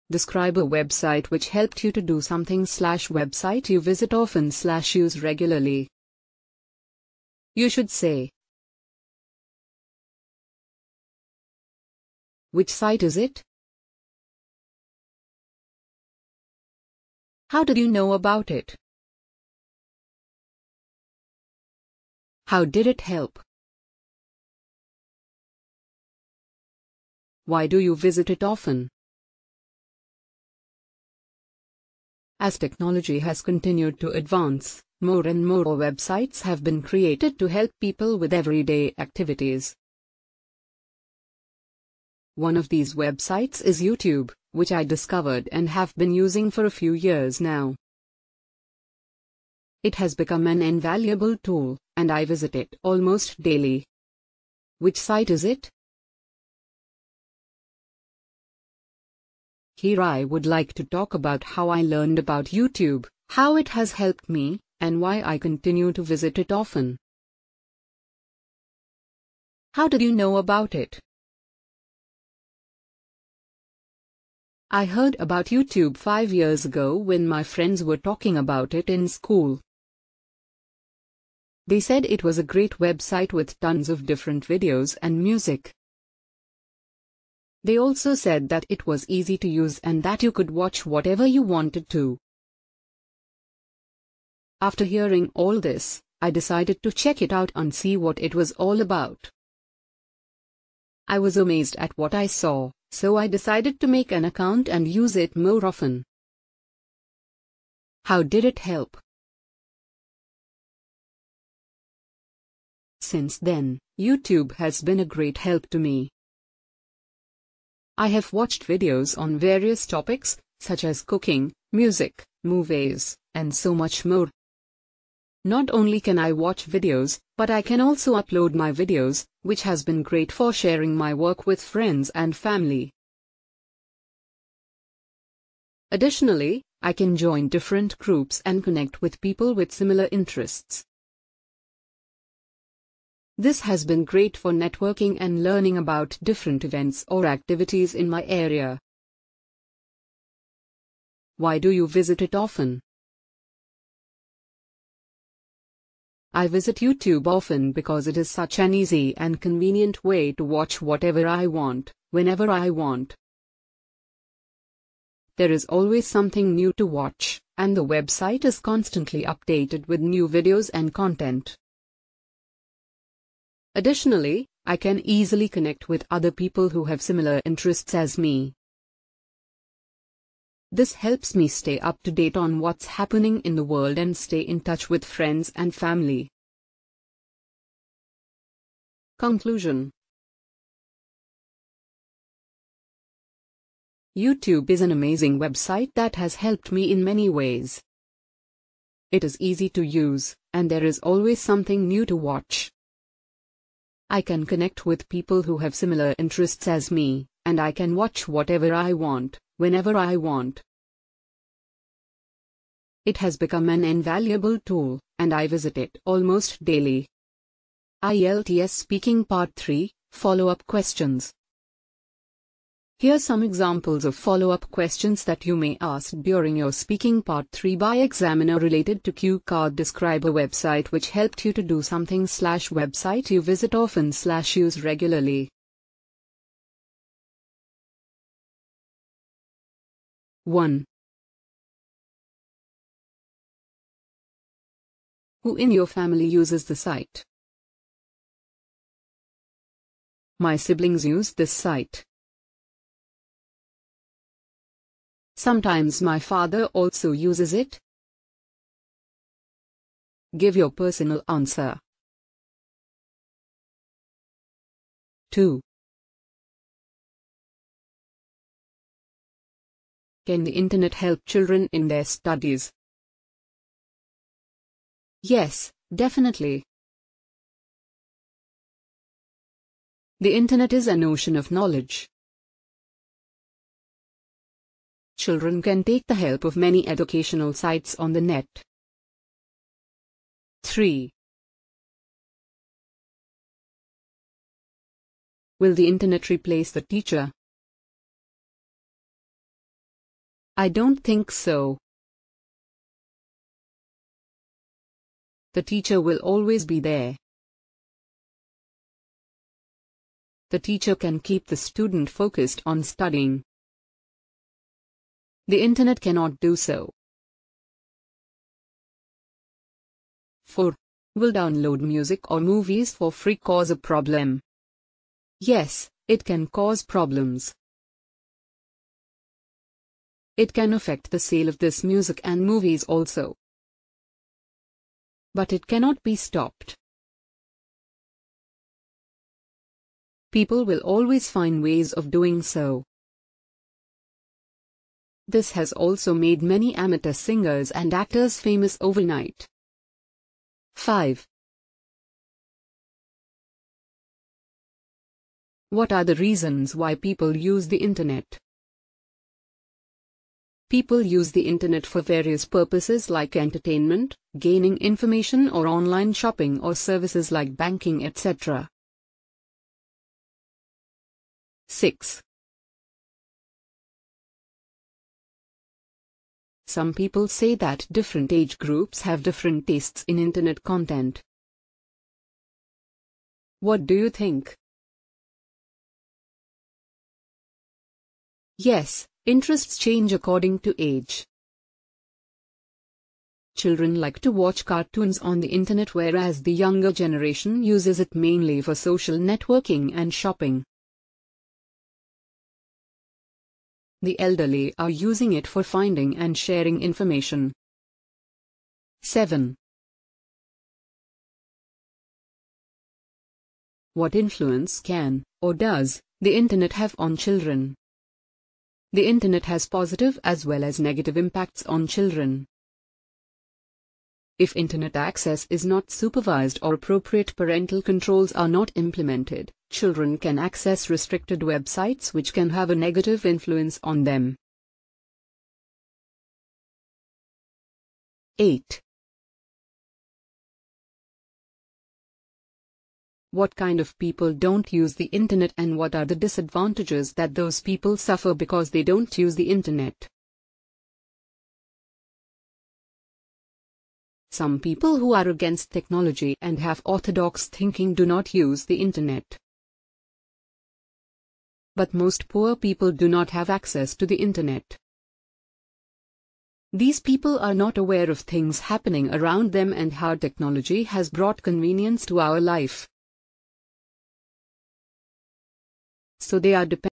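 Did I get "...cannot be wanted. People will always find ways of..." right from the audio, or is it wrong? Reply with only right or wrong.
wrong.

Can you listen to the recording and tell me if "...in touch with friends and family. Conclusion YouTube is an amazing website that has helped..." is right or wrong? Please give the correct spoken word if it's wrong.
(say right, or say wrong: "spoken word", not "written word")
right.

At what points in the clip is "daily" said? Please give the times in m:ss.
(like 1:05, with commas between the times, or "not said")
0:53, 3:36.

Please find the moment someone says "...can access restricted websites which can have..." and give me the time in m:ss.
7:10.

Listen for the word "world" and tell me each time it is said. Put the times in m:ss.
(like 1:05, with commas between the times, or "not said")
3:03.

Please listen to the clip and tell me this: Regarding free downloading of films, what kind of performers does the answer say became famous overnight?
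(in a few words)
amateur singers and actors.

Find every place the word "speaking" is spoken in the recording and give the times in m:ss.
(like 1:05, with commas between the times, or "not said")
3:38, 3:46.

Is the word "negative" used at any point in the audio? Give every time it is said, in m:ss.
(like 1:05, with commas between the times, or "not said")
7:00, 7:12.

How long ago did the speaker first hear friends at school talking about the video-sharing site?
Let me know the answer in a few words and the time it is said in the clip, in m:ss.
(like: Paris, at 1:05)
5 years ago, at 1:15.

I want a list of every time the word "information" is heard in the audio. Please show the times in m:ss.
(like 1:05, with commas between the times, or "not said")
6:04, 6:46.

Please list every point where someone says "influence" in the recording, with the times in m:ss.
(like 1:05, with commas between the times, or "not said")
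6:54, 7:13.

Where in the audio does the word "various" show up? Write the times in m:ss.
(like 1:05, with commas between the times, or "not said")
1:59, 6:02.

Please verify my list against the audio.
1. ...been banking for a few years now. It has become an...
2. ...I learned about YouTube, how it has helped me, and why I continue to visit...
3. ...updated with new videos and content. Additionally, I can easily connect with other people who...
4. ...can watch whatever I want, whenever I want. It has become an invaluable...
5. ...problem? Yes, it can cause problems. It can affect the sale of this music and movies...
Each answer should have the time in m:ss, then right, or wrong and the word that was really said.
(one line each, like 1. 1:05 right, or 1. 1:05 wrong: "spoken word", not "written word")
1. 0:45 wrong: "using", not "banking"
2. 1:01 right
3. 2:49 right
4. 3:27 right
5. 5:23 right.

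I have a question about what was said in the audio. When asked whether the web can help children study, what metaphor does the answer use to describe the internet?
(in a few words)
an ocean of knowledge.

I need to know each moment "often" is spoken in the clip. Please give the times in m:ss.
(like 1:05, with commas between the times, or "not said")
0:04, 0:28, 1:06, 1:45, 2:32, 2:37, 3:53.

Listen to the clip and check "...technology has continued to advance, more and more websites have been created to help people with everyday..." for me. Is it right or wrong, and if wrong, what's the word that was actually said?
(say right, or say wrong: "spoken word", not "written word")
right.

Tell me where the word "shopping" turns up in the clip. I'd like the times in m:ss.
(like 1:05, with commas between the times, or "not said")
6:06, 6:40.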